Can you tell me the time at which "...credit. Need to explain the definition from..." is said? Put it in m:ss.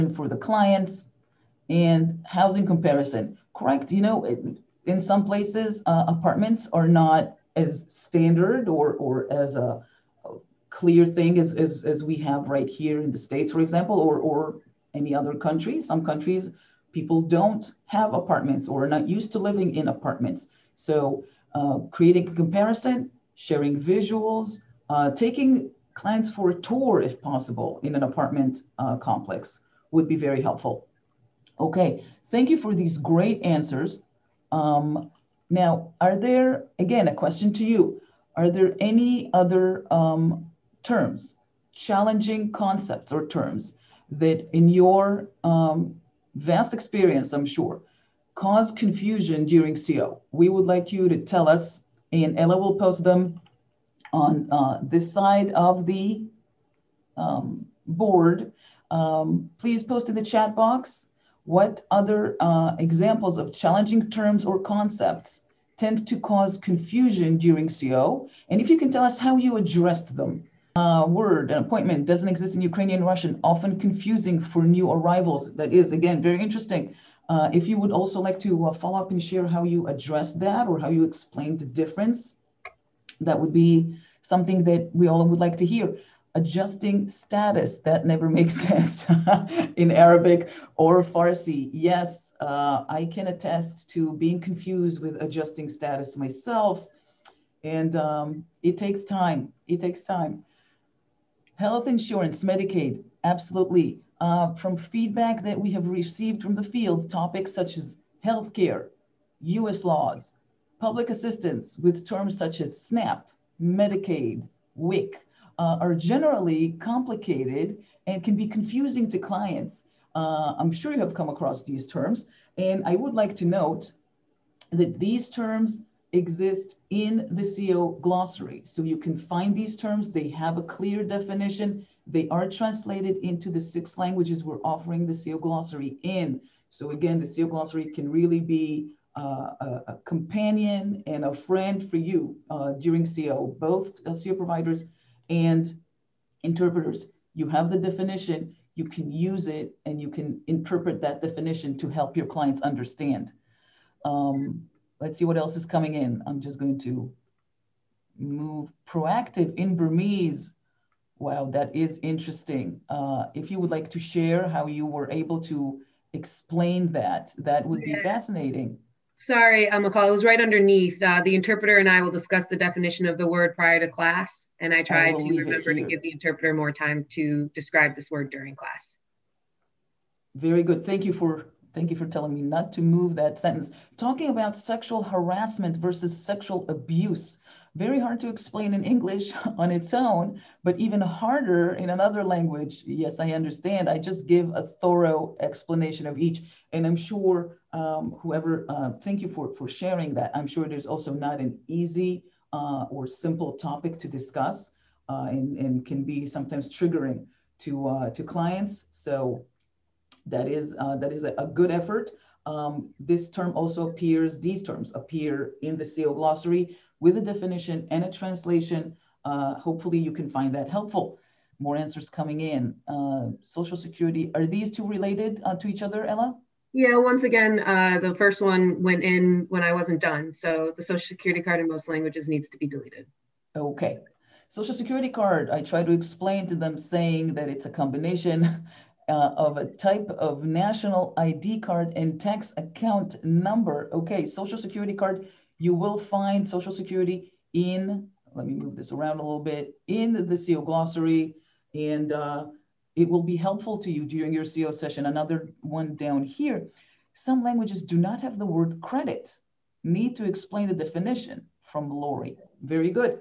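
4:18.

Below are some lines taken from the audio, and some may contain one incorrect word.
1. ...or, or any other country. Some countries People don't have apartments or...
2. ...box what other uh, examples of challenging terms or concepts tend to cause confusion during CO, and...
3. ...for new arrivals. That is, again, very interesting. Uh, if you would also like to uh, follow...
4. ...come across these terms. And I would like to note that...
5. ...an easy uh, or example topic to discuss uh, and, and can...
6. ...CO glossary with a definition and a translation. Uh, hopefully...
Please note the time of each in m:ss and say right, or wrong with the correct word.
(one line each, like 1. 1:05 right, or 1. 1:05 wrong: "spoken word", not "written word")
1. 0:13 right
2. 1:00 right
3. 1:14 right
4. 2:01 right
5. 3:21 wrong: "simple", not "example"
6. 3:35 right.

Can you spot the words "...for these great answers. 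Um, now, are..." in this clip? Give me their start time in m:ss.
0:32.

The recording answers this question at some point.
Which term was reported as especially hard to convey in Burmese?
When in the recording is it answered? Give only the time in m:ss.
2:38.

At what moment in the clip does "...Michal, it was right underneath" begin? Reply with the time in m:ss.
2:49.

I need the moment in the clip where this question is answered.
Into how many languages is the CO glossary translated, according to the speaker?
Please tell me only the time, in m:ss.
2:13.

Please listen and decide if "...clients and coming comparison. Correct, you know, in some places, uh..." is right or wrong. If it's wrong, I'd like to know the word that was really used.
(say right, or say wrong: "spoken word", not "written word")
wrong: "housing", not "coming".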